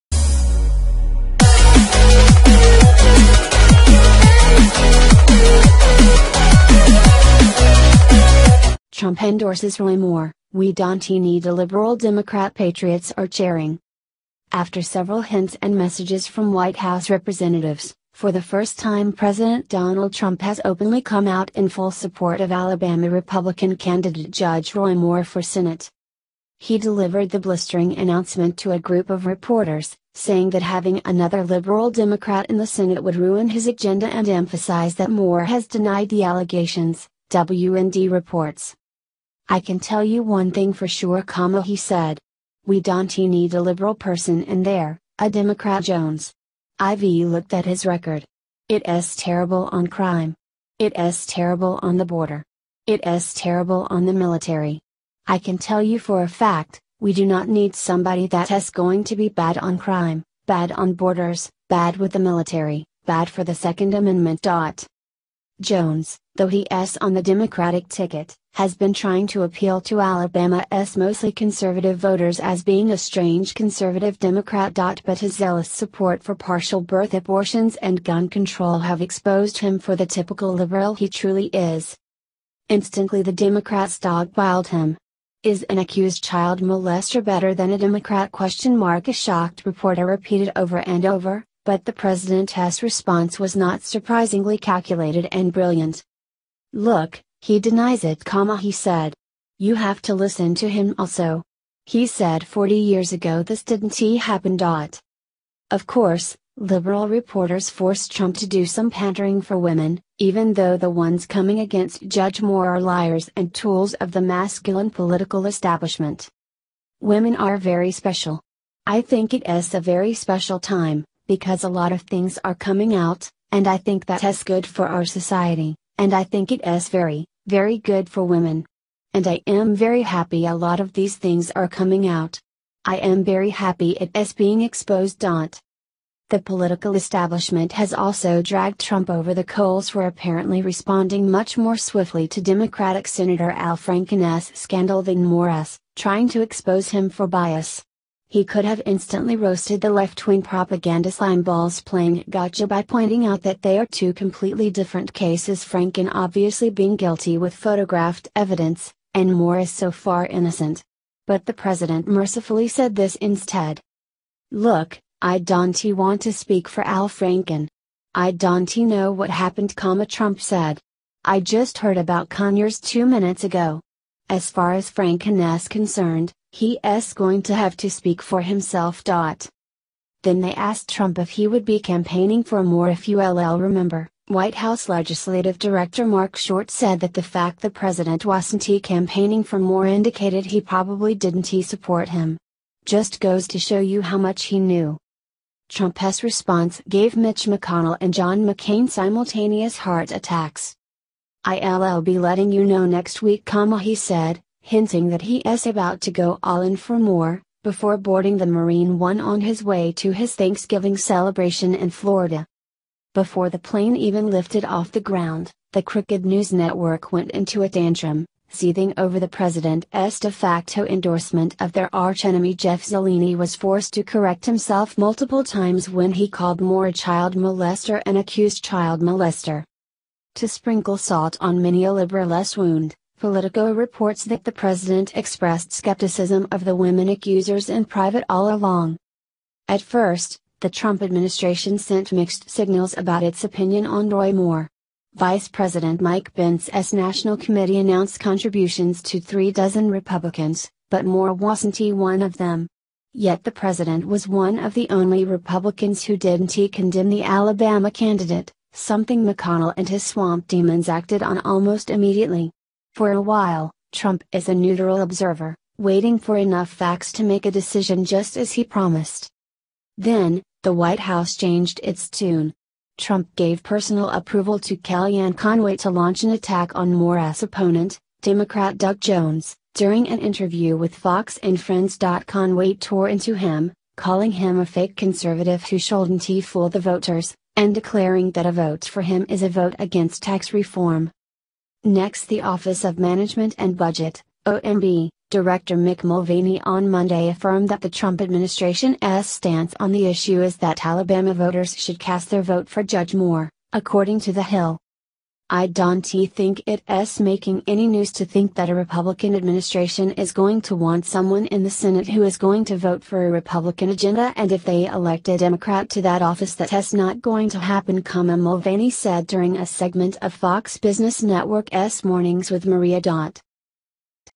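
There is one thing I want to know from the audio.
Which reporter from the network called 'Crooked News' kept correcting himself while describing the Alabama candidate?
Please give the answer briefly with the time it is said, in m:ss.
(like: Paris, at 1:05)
Jeff Zeleny, at 3:42.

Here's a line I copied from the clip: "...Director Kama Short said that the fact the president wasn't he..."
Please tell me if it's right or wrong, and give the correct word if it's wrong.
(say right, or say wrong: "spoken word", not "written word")
wrong: "Mark", not "Kama".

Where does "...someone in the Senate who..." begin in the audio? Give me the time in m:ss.
5:11.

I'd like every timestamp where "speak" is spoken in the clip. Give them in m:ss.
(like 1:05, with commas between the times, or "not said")
2:46, 2:57.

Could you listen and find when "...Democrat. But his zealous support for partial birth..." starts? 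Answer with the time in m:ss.
1:14.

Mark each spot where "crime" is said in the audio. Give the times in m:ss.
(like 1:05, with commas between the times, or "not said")
0:49, 0:59.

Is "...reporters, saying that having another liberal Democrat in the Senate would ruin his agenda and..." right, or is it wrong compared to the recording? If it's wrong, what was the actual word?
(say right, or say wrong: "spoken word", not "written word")
right.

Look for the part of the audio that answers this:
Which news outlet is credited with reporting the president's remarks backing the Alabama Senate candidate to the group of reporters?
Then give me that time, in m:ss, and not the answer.
0:37.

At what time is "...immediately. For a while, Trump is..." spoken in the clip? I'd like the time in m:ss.
4:21.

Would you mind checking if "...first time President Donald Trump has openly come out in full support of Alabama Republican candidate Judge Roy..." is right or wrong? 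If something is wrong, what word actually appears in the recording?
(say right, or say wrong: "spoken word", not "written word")
right.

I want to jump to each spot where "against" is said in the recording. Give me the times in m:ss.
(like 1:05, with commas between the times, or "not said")
1:51, 4:49.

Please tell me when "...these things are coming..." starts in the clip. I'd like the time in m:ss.
2:10.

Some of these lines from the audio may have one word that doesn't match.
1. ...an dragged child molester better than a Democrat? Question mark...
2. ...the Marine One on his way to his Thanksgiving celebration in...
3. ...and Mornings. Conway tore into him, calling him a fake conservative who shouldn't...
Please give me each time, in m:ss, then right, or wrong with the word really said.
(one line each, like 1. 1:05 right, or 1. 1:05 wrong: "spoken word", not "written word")
1. 1:25 wrong: "accused", not "dragged"
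2. 3:28 right
3. 4:41 wrong: "Friends", not "Mornings".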